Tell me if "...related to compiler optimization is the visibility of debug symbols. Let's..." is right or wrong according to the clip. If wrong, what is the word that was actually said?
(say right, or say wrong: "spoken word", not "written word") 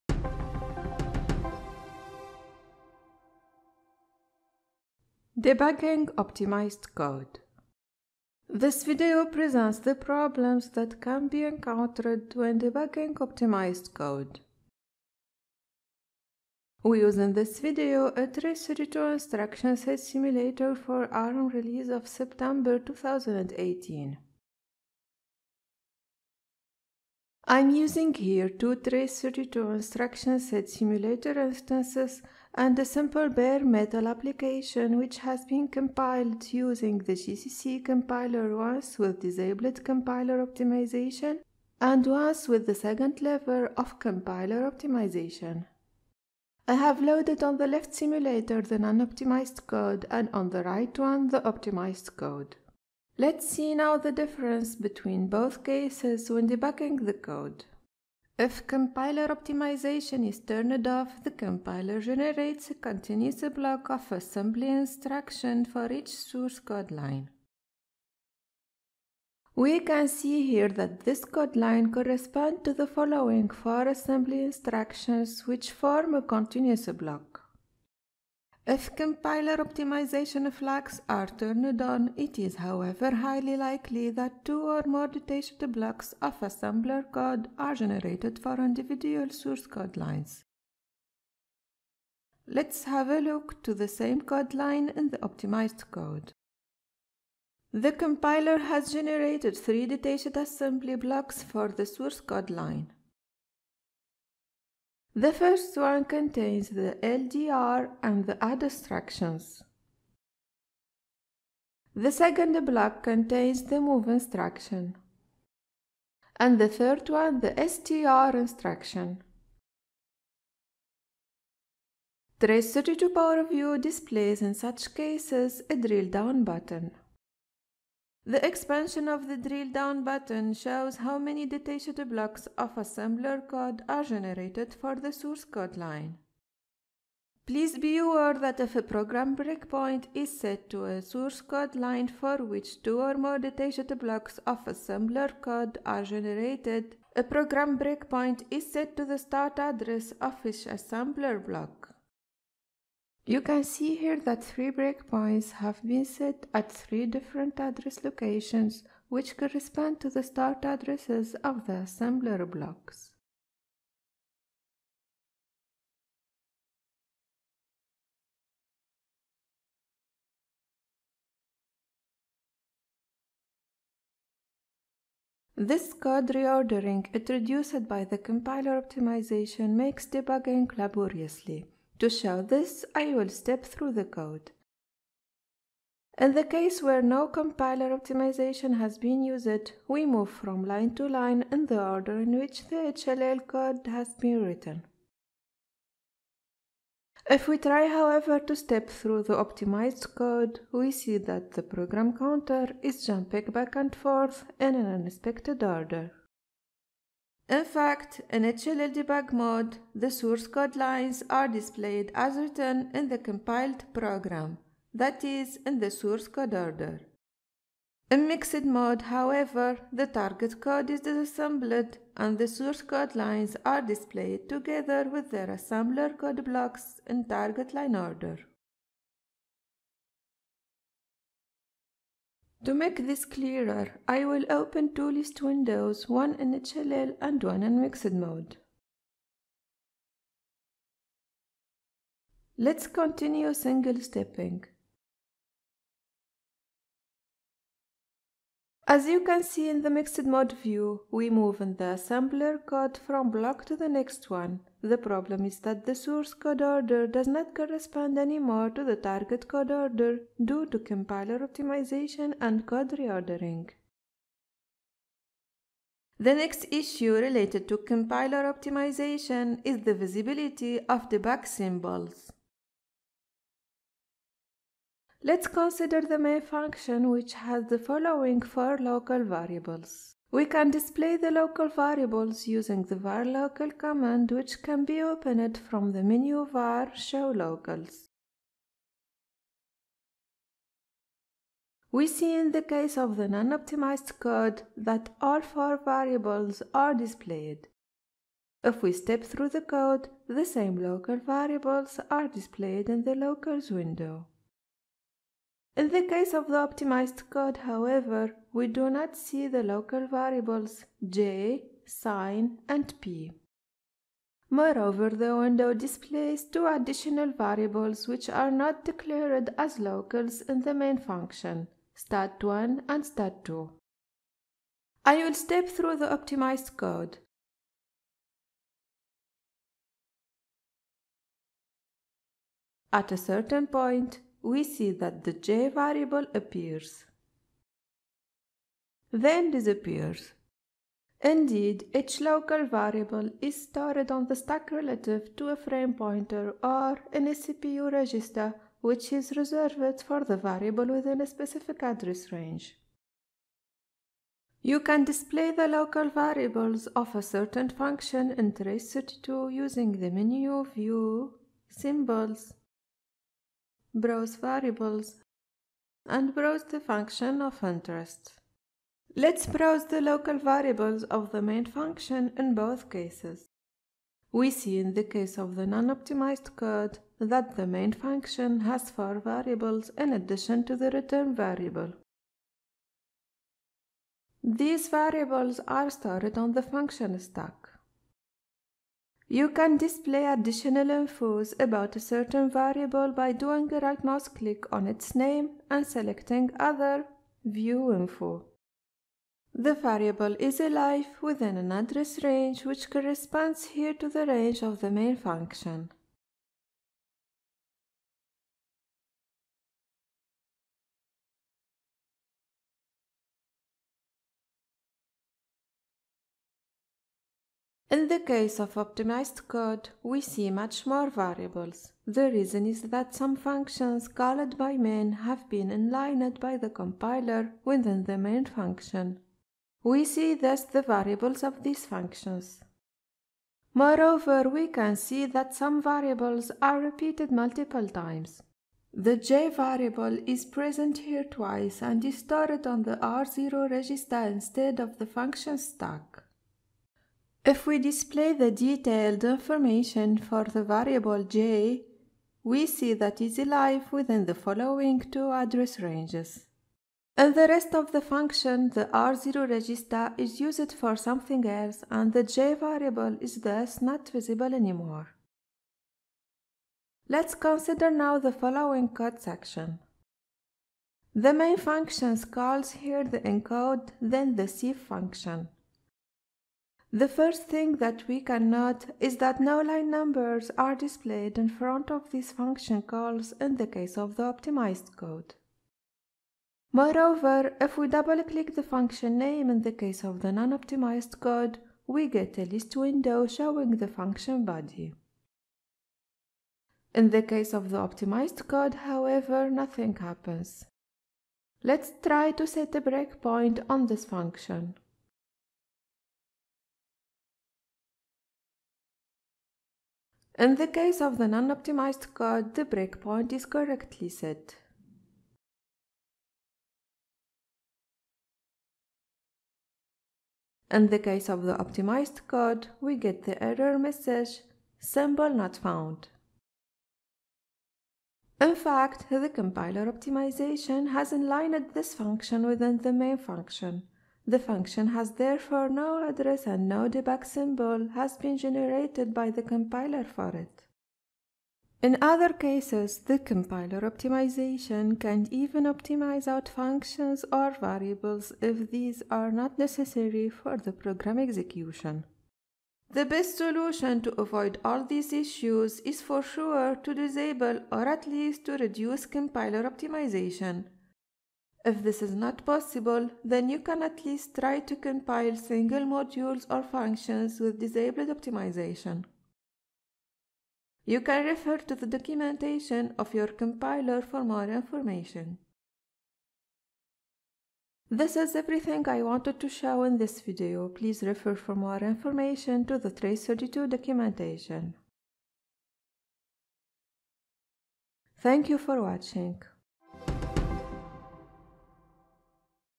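right.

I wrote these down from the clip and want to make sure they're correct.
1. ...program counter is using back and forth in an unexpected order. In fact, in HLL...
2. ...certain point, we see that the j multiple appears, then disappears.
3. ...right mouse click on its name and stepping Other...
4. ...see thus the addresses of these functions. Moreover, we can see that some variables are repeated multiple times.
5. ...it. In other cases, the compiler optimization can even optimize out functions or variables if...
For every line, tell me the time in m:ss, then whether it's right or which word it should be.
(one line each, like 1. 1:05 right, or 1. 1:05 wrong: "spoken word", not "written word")
1. 3:21 wrong: "jumping", not "using"
2. 5:33 wrong: "variable", not "multiple"
3. 6:33 wrong: "selecting", not "stepping"
4. 7:10 wrong: "variables", not "addresses"
5. 9:00 right.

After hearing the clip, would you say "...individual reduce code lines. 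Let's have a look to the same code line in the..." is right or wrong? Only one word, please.
wrong.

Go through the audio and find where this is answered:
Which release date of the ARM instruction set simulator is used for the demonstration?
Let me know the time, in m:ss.
0:22.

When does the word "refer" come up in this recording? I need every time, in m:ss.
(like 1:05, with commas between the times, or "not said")
9:31, 9:41.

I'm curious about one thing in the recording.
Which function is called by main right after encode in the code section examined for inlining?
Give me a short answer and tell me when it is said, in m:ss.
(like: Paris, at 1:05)
sieve, at 7:54.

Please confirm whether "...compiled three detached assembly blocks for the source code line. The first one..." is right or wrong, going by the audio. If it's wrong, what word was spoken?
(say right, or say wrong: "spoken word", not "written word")
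wrong: "generated", not "compiled".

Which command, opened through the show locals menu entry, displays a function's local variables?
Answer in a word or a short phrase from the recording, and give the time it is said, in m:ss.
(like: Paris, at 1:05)
var local, at 4:42.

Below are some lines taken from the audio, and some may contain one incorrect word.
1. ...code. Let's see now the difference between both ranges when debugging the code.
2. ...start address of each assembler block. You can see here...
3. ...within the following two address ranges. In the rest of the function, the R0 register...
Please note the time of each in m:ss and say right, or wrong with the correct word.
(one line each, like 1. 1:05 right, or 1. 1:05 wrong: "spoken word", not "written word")
1. 0:52 wrong: "cases", not "ranges"
2. 2:29 right
3. 7:33 right.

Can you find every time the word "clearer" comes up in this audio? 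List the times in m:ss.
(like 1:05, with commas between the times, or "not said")
3:53.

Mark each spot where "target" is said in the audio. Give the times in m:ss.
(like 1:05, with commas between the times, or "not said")
3:40, 3:47, 4:18.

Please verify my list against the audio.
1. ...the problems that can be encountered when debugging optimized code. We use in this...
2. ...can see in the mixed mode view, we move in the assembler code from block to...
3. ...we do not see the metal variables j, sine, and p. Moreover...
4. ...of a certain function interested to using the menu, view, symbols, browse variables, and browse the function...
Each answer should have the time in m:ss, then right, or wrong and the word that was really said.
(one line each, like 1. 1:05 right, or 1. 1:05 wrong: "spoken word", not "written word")
1. 0:09 right
2. 4:09 right
3. 5:08 wrong: "local", not "metal"
4. 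5:56 right.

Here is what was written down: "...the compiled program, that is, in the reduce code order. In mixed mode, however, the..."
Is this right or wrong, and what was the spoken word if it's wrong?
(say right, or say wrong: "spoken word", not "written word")
wrong: "source", not "reduce".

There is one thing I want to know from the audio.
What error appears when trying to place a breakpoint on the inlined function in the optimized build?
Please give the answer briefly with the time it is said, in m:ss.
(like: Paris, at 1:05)
Symbol not found, at 8:44.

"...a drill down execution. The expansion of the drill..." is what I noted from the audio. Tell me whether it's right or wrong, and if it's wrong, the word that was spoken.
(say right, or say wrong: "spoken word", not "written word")
wrong: "button", not "execution".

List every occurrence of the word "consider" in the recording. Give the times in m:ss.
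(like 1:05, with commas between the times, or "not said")
4:35, 7:47.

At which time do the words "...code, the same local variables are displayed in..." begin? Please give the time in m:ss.
4:59.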